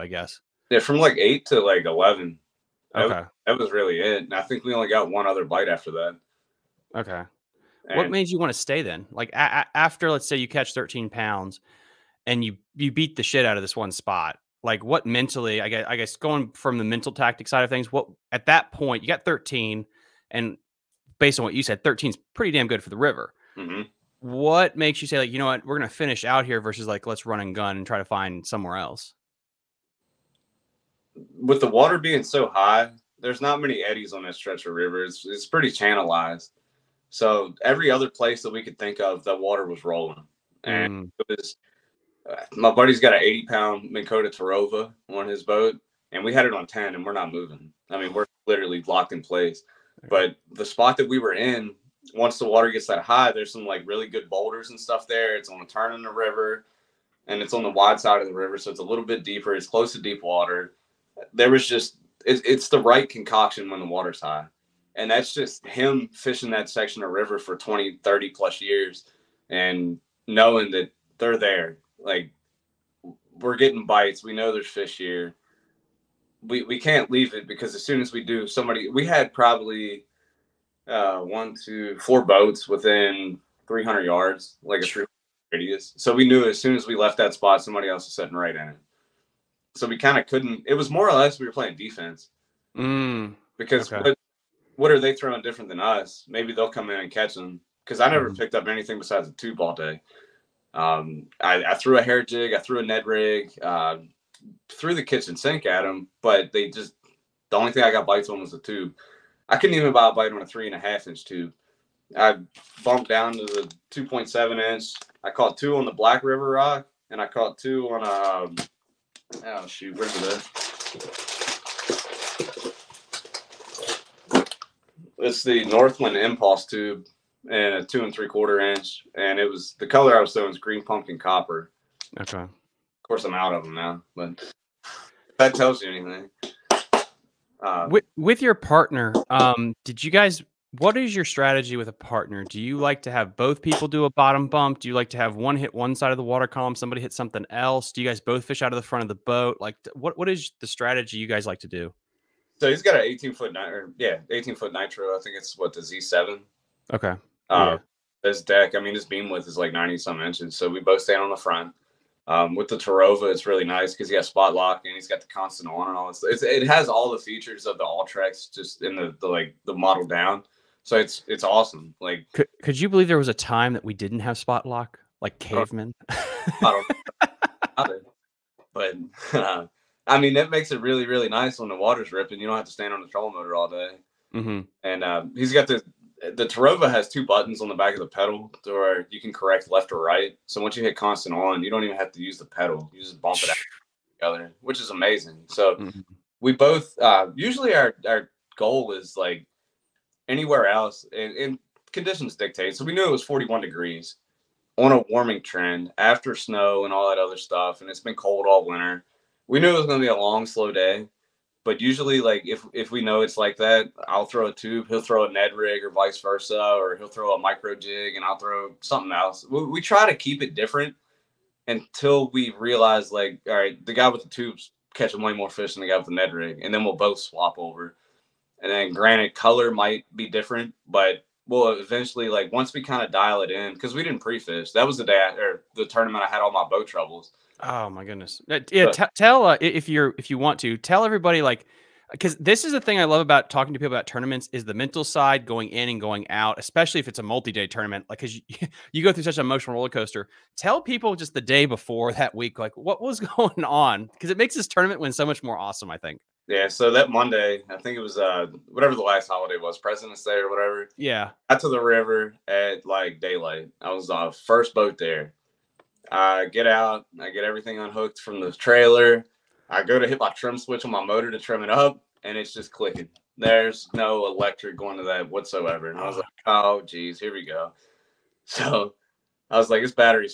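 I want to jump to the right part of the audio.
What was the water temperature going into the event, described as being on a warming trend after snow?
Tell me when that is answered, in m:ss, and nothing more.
3:23.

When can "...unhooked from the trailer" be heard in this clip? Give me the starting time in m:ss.
4:27.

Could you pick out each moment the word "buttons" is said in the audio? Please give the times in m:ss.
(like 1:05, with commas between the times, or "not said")
3:07.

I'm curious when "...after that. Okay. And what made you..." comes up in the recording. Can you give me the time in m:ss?
0:05.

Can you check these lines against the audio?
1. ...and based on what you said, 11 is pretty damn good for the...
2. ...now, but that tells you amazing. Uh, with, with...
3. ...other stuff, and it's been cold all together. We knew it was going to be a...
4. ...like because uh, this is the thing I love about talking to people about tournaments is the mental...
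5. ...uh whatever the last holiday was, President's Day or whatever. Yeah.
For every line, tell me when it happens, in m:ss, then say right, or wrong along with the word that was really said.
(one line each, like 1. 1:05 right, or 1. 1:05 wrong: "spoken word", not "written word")
1. 0:20 wrong: "13", not "11"
2. 2:13 wrong: "anything", not "amazing"
3. 3:27 wrong: "winter", not "together"
4. 4:01 right
5. 4:18 right.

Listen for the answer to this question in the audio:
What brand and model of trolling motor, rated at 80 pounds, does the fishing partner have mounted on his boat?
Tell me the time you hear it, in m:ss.
0:43.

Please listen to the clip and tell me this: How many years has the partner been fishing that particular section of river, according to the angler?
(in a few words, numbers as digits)
20 to 30 plus.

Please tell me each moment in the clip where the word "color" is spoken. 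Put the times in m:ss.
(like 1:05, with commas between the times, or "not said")
2:09, 3:49.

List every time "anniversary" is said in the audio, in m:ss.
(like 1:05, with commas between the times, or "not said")
not said.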